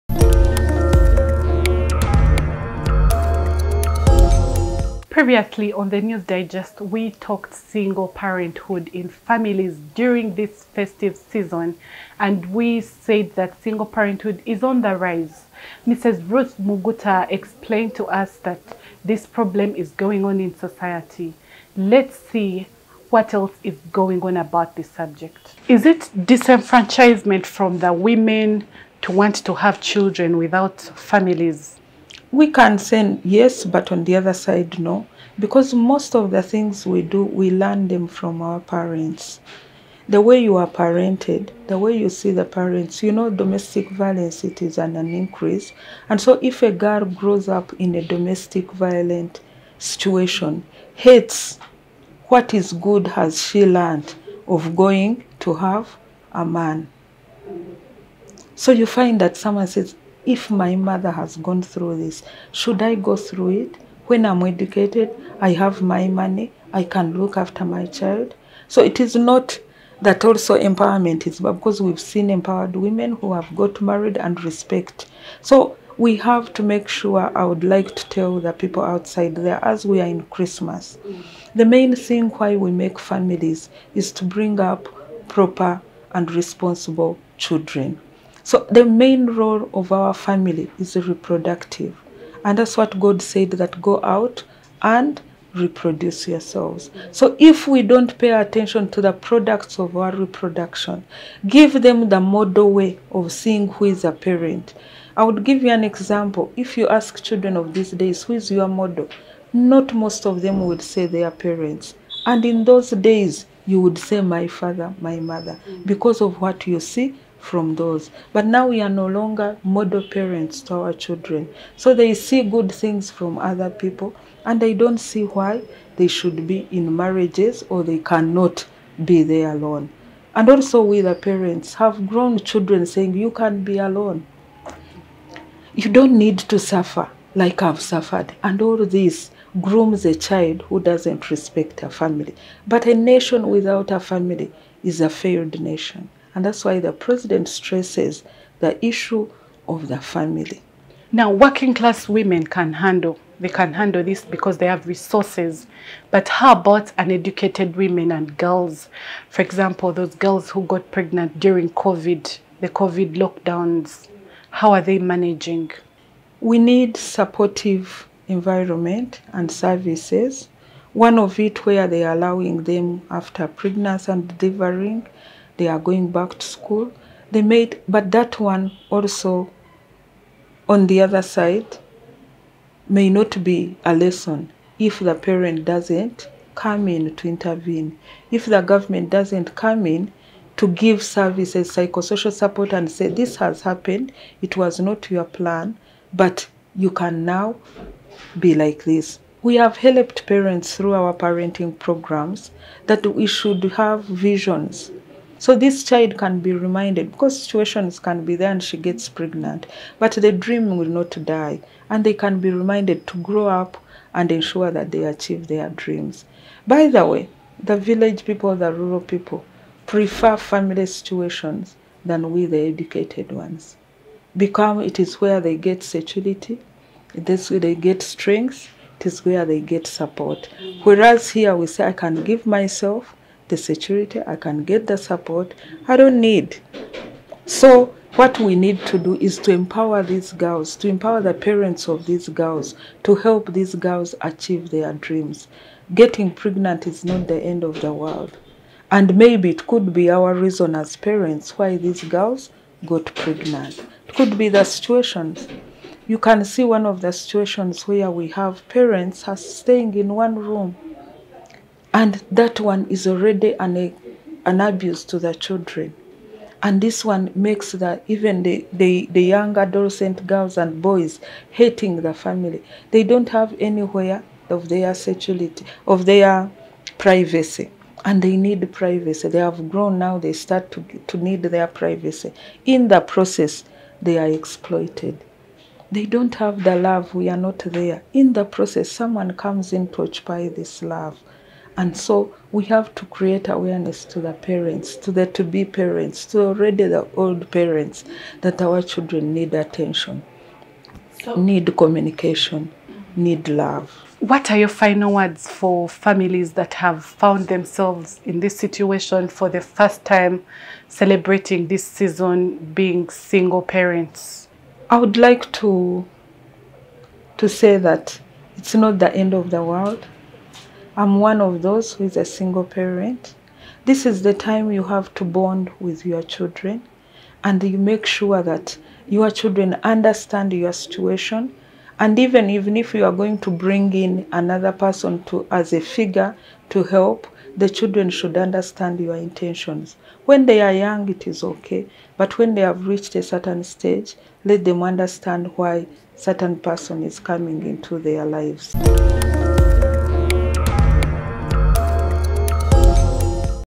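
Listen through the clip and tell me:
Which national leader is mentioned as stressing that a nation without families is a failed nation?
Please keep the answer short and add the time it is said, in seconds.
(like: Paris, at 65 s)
the president, at 146 s.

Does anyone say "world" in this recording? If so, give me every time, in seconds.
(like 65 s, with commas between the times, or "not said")
247 s, 319 s.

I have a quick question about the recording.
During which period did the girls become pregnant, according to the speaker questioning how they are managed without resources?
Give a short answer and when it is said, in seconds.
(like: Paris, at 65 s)
COVID lockdowns, at 162 s.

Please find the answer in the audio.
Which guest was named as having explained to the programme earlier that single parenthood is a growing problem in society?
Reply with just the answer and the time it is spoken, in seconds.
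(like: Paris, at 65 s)
Ruth Muguta, at 16 s.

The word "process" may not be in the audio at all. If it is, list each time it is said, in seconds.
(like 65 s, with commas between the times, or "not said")
283 s, 288 s.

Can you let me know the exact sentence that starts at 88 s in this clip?
So the main role of our family is reproductive.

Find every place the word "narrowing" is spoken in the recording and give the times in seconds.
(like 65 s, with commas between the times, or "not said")
not said.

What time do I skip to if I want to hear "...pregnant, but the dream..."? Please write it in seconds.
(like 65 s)
209 s.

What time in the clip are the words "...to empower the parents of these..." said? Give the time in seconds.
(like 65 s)
240 s.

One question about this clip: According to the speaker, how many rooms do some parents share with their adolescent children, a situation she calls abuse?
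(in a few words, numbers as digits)
1.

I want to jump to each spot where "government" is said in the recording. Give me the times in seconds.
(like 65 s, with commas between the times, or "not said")
188 s.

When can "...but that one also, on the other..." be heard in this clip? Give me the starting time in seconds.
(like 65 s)
177 s.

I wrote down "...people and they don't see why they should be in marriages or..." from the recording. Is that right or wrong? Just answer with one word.
right.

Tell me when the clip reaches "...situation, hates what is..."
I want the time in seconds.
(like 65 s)
49 s.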